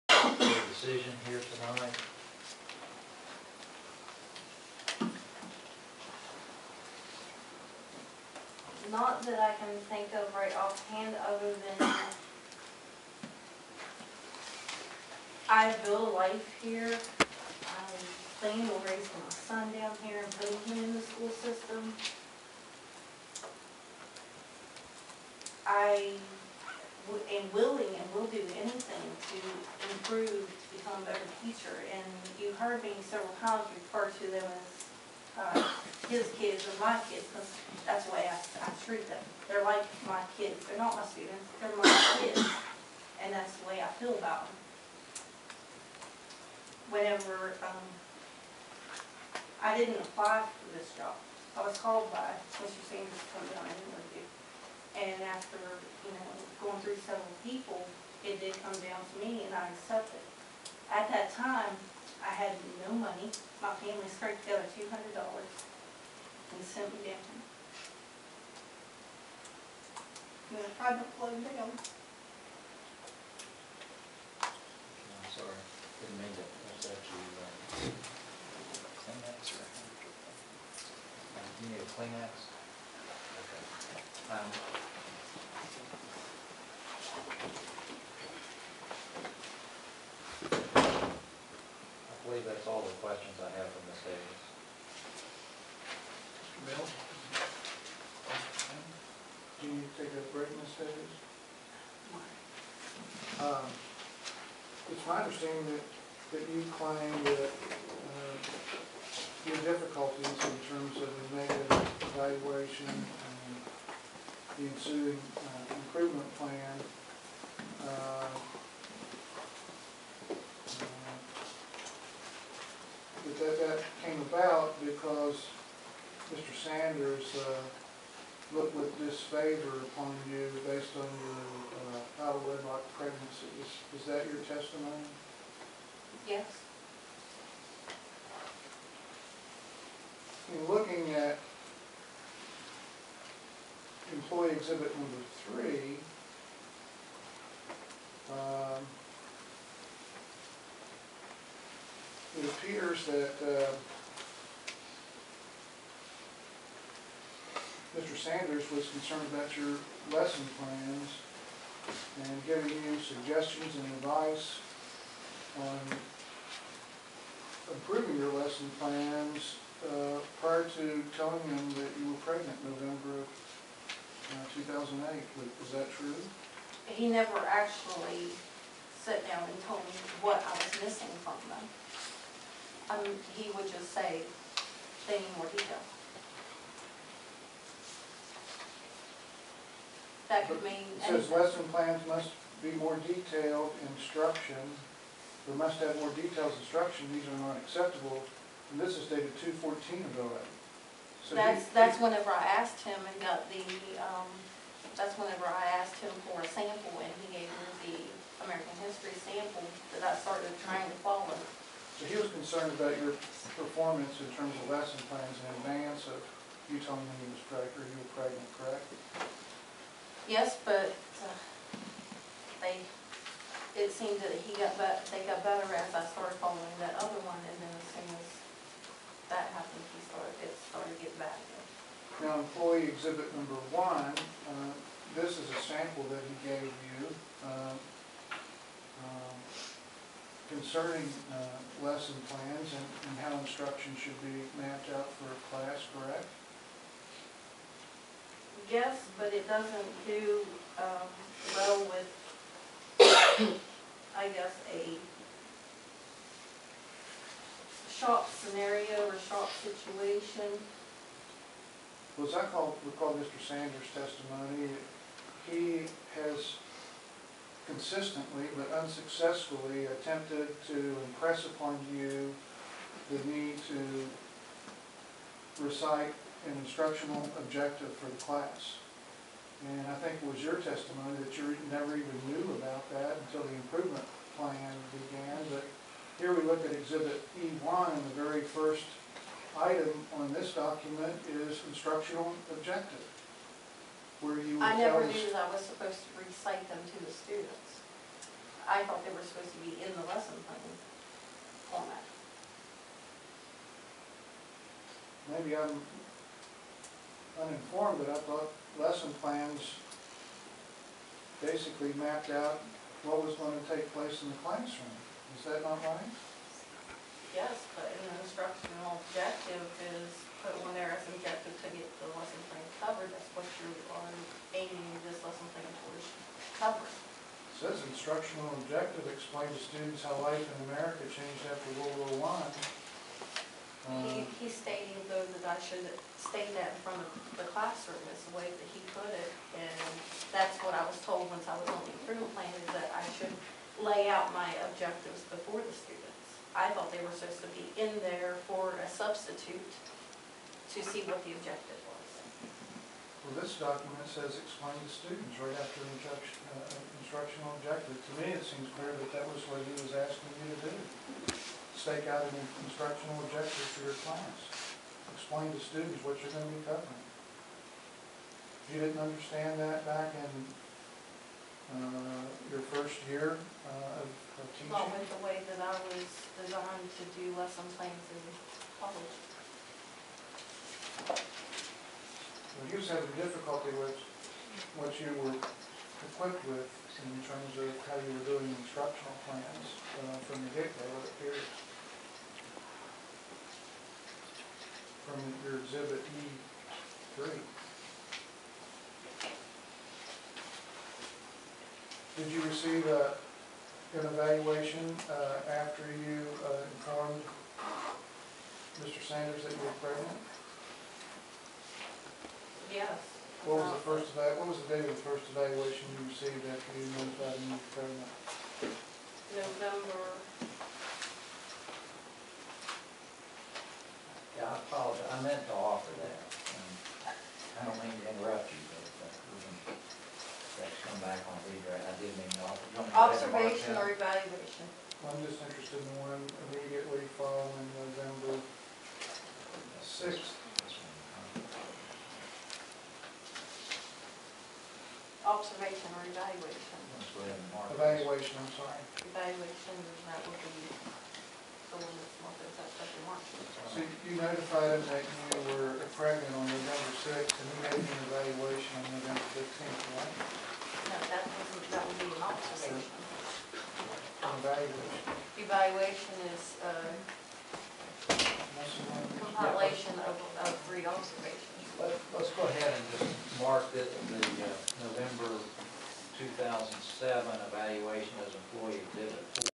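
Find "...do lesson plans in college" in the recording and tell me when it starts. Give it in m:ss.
6:17.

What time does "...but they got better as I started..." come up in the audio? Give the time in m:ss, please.
3:44.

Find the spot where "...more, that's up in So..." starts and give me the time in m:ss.
7:32.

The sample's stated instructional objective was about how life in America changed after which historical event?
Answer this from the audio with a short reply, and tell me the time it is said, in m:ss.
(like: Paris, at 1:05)
World War I, at 5:31.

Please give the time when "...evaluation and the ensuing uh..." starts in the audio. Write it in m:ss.
1:52.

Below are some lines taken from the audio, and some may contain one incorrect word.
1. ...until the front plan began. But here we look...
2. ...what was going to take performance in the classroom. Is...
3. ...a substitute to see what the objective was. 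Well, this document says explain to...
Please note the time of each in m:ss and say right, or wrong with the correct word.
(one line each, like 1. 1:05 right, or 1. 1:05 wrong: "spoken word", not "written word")
1. 4:43 wrong: "improvement", not "front"
2. 5:13 wrong: "place", not "performance"
3. 5:48 right.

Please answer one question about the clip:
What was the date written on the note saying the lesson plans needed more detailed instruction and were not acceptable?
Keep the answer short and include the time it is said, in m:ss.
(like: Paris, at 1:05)
2/14/08, at 3:19.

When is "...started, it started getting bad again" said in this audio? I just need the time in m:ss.
3:50.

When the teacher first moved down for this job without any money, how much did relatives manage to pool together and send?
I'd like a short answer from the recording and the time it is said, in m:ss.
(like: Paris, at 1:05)
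$200, at 1:04.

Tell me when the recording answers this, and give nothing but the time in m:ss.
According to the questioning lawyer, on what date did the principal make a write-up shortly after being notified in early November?
7:38.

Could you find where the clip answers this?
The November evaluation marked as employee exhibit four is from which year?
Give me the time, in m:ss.
7:56.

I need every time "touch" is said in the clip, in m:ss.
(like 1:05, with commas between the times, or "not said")
not said.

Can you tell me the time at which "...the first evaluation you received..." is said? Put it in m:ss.
6:54.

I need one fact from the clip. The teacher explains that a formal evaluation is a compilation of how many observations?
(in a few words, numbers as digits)
3 observations.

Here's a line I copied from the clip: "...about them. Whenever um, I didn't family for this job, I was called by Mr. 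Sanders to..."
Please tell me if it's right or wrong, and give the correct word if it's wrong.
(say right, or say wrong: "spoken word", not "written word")
wrong: "apply", not "family".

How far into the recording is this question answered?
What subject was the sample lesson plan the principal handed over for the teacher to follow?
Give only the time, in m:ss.
3:28.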